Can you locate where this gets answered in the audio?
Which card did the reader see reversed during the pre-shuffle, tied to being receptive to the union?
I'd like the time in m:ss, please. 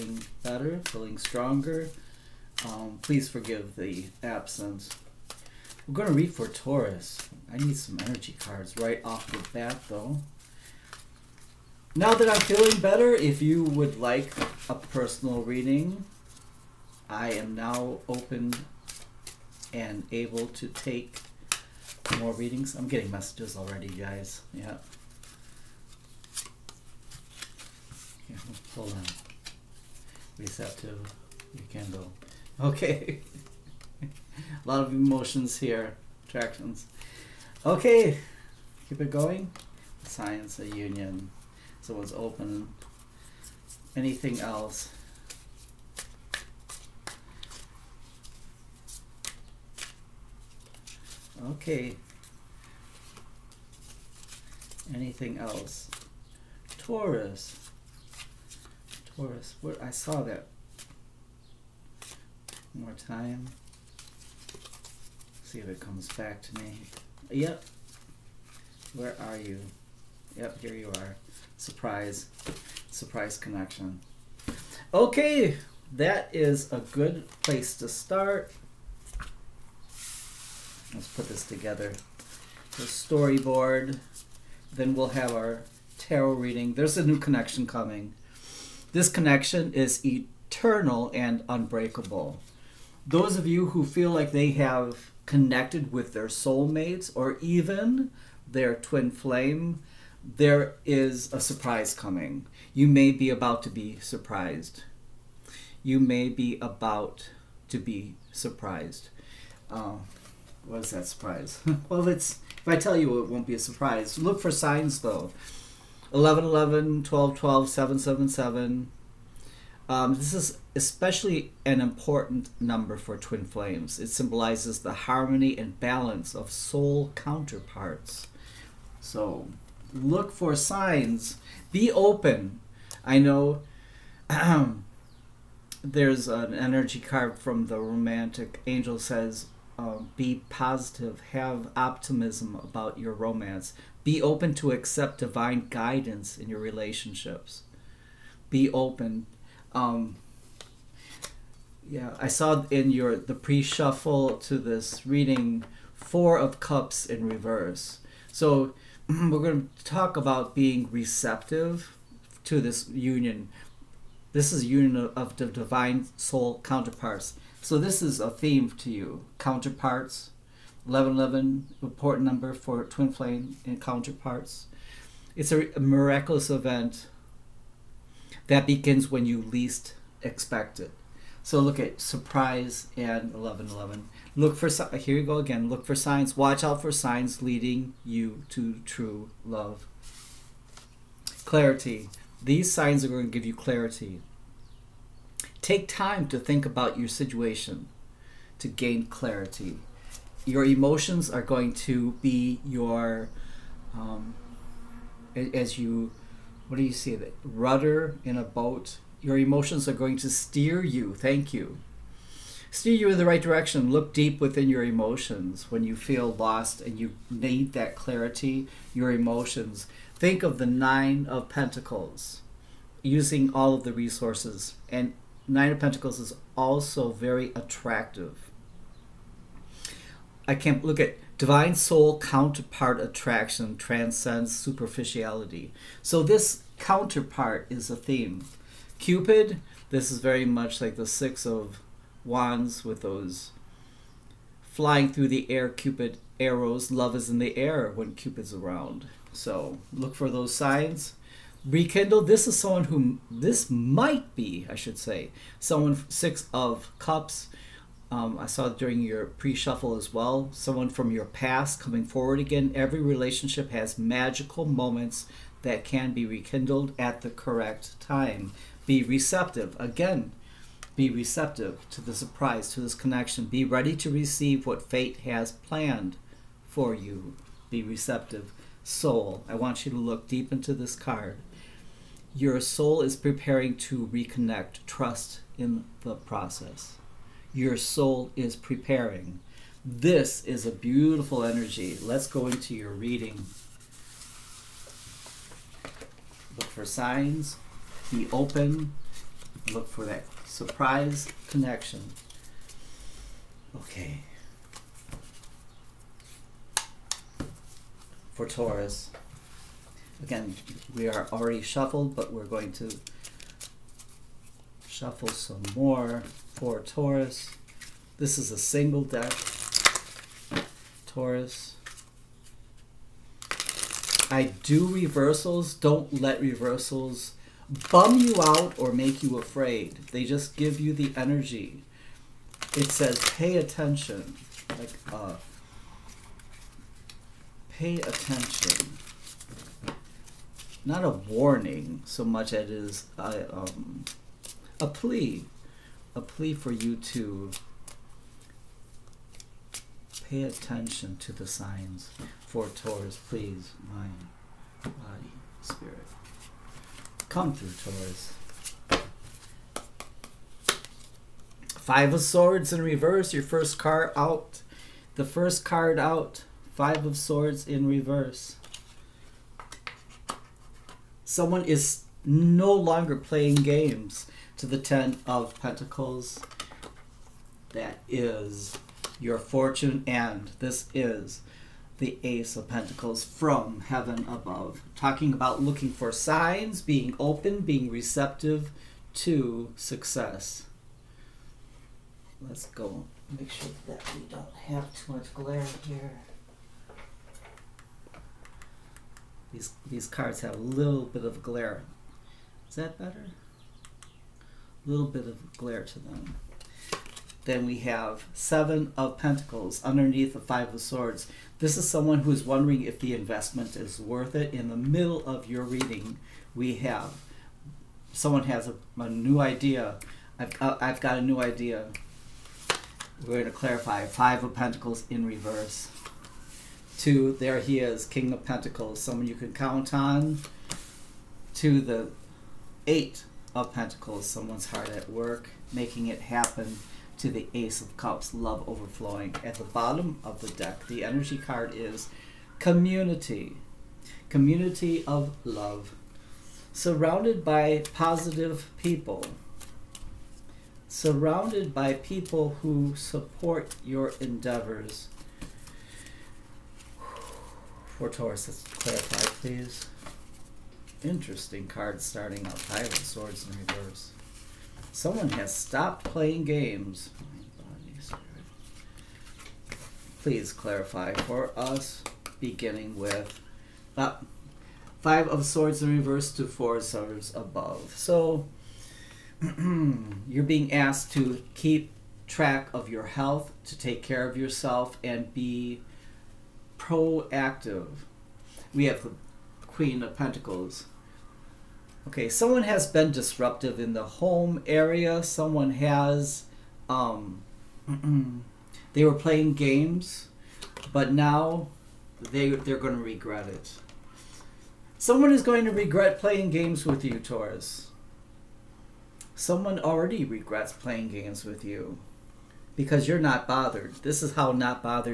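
2:35.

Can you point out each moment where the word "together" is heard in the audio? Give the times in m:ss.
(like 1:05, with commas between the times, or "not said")
1:21.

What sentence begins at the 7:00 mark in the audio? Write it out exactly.
I've, uh, I've got a new idea.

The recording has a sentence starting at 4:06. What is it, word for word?
Love is in the air when Cupid's around.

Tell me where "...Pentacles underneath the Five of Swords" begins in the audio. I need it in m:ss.
6:49.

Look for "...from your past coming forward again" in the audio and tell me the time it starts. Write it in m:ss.
4:20.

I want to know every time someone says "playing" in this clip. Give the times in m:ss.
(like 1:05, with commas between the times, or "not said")
6:13, 7:46, 8:19, 8:26, 8:30.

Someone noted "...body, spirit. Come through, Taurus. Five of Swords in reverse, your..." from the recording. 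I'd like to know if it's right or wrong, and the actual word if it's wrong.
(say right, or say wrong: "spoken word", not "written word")
right.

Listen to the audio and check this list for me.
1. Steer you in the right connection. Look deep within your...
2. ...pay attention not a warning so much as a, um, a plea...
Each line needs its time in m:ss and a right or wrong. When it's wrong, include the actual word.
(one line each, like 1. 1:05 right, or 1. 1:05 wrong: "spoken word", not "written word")
1. 3:32 wrong: "direction", not "connection"
2. 5:37 right.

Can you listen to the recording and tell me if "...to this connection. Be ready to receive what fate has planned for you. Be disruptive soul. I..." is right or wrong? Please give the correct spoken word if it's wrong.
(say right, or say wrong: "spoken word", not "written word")
wrong: "receptive", not "disruptive".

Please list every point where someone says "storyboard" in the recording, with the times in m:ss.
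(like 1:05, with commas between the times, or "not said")
1:22.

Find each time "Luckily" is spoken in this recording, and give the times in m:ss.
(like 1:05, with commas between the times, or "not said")
not said.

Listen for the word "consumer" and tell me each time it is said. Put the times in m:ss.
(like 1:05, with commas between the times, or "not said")
not said.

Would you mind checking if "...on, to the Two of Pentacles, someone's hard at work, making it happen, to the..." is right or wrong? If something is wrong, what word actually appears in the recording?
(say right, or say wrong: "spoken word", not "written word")
wrong: "Eight", not "Two".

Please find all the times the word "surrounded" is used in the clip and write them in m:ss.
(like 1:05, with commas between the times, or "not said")
7:26, 7:30.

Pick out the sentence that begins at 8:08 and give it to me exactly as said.
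We have the Queen of Pentacles.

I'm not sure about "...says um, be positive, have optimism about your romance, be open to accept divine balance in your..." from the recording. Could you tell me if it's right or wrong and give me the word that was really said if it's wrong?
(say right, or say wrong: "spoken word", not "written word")
wrong: "guidance", not "balance".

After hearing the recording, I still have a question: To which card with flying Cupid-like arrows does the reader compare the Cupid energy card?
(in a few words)
Six of Wands.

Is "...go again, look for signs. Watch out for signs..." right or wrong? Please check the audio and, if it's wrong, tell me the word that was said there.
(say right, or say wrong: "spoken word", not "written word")
right.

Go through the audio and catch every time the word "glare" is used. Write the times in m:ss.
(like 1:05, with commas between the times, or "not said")
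6:35, 6:41, 6:45.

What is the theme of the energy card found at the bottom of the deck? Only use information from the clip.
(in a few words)
Community of love.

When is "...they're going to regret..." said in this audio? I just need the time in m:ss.
8:22.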